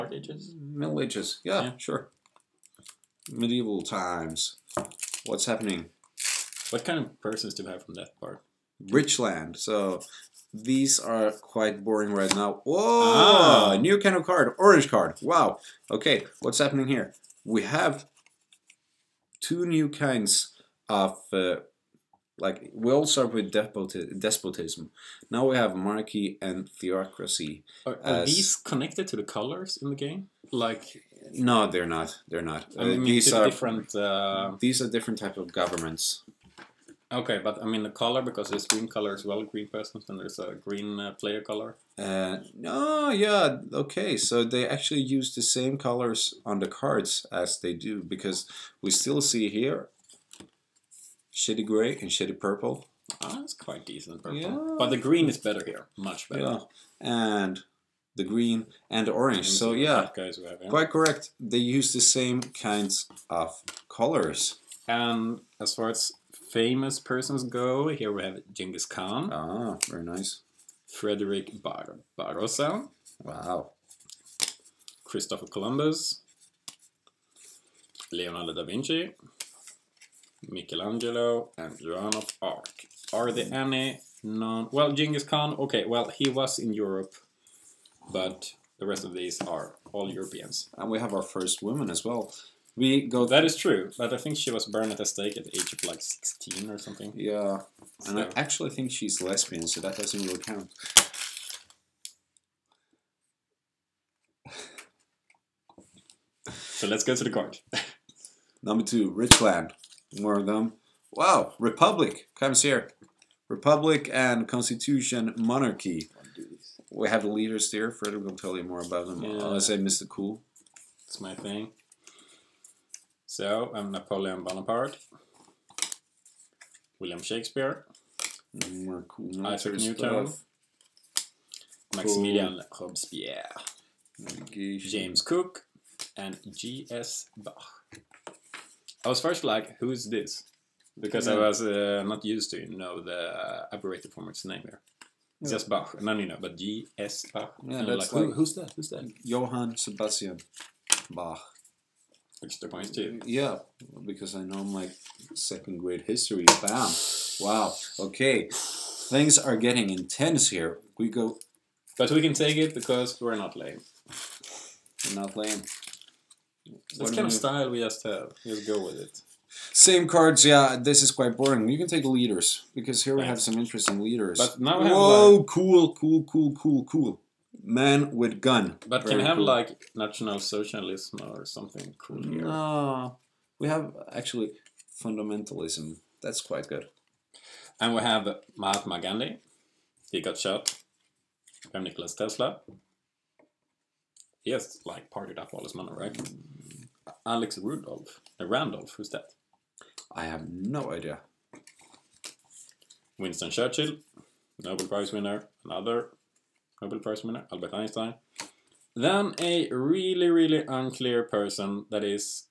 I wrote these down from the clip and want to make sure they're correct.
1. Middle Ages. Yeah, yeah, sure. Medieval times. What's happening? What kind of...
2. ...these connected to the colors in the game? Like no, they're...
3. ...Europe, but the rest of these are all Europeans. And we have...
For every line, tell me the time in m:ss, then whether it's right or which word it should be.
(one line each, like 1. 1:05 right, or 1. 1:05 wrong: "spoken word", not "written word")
1. 0:00 right
2. 0:28 right
3. 1:26 right.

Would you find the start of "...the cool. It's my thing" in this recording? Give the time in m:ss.
1:59.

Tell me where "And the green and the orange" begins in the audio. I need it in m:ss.
0:56.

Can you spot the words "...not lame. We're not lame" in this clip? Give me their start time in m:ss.
2:43.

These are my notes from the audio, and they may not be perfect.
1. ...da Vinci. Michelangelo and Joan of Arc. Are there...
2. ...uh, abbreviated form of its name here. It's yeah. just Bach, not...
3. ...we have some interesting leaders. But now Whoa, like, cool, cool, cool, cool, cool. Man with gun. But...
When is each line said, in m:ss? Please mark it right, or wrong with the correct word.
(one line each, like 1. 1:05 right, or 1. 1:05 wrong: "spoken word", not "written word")
1. 1:18 right
2. 2:23 right
3. 2:53 right.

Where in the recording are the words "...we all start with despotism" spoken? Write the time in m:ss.
0:22.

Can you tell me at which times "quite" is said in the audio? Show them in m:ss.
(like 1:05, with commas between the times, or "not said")
0:11, 0:53, 1:00, 2:51, 3:06.